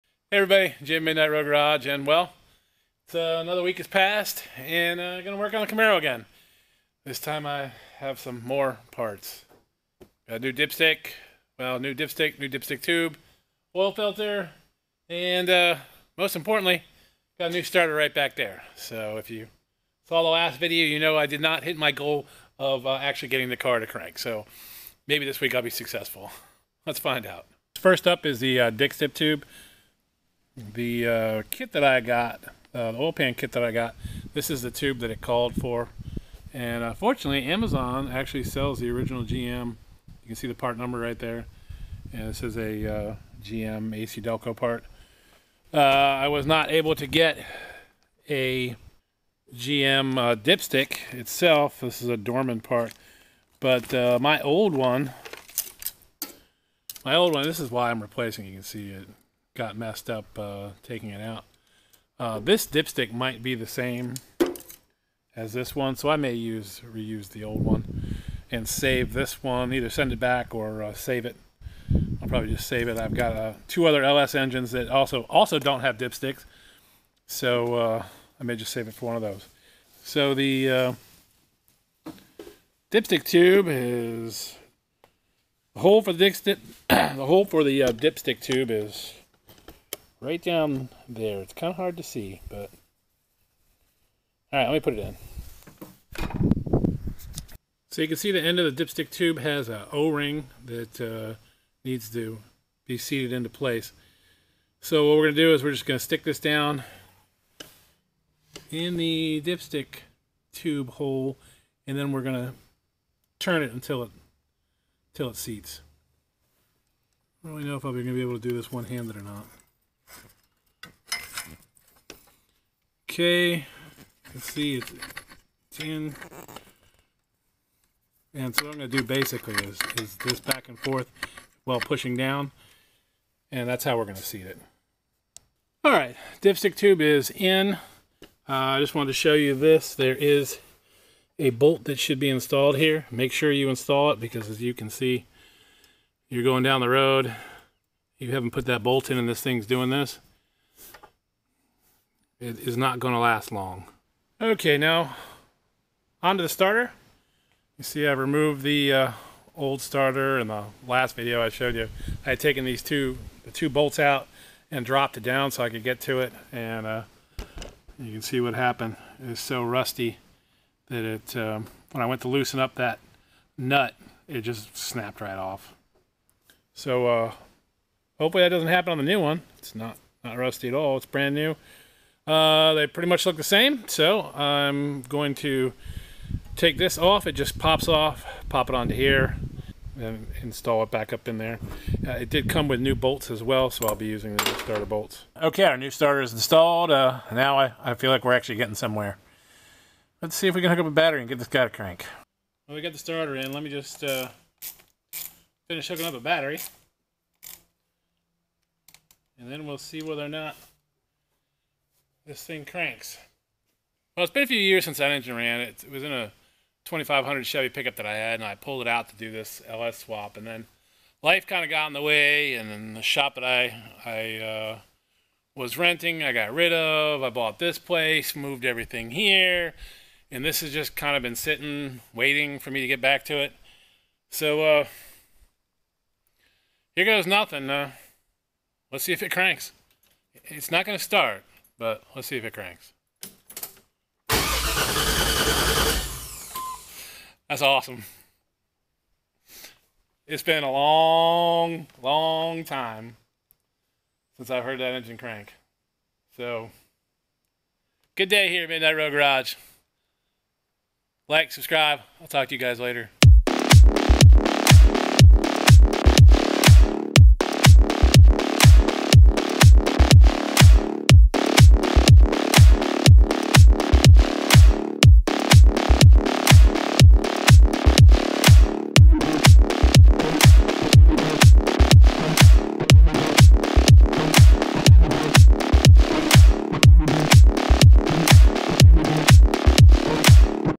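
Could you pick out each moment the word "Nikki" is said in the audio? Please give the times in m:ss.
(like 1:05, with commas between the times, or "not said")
not said.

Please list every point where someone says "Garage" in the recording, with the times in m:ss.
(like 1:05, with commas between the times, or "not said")
0:01, 4:19.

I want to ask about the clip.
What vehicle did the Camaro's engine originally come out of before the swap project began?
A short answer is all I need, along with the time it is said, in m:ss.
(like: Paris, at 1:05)
2500 Chevy pickup, at 3:36.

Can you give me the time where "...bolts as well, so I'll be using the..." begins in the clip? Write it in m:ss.
3:12.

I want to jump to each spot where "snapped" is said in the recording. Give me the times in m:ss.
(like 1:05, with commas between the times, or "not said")
2:54.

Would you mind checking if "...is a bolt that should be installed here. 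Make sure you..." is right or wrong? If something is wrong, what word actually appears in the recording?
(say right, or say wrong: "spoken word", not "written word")
right.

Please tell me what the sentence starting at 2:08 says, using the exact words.
And so what I'm going to do basically is, is this back and forth while pushing down.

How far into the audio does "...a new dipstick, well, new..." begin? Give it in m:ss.
0:10.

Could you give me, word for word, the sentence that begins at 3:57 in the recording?
Uh, let's see if it cranks.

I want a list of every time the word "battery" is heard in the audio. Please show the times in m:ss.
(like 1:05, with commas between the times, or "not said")
3:20, 3:26.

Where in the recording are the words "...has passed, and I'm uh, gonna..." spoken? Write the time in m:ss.
0:03.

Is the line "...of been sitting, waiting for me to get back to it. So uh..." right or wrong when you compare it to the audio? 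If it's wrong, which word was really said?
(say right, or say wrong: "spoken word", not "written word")
right.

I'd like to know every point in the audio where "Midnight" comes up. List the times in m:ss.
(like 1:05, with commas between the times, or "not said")
0:01, 4:18.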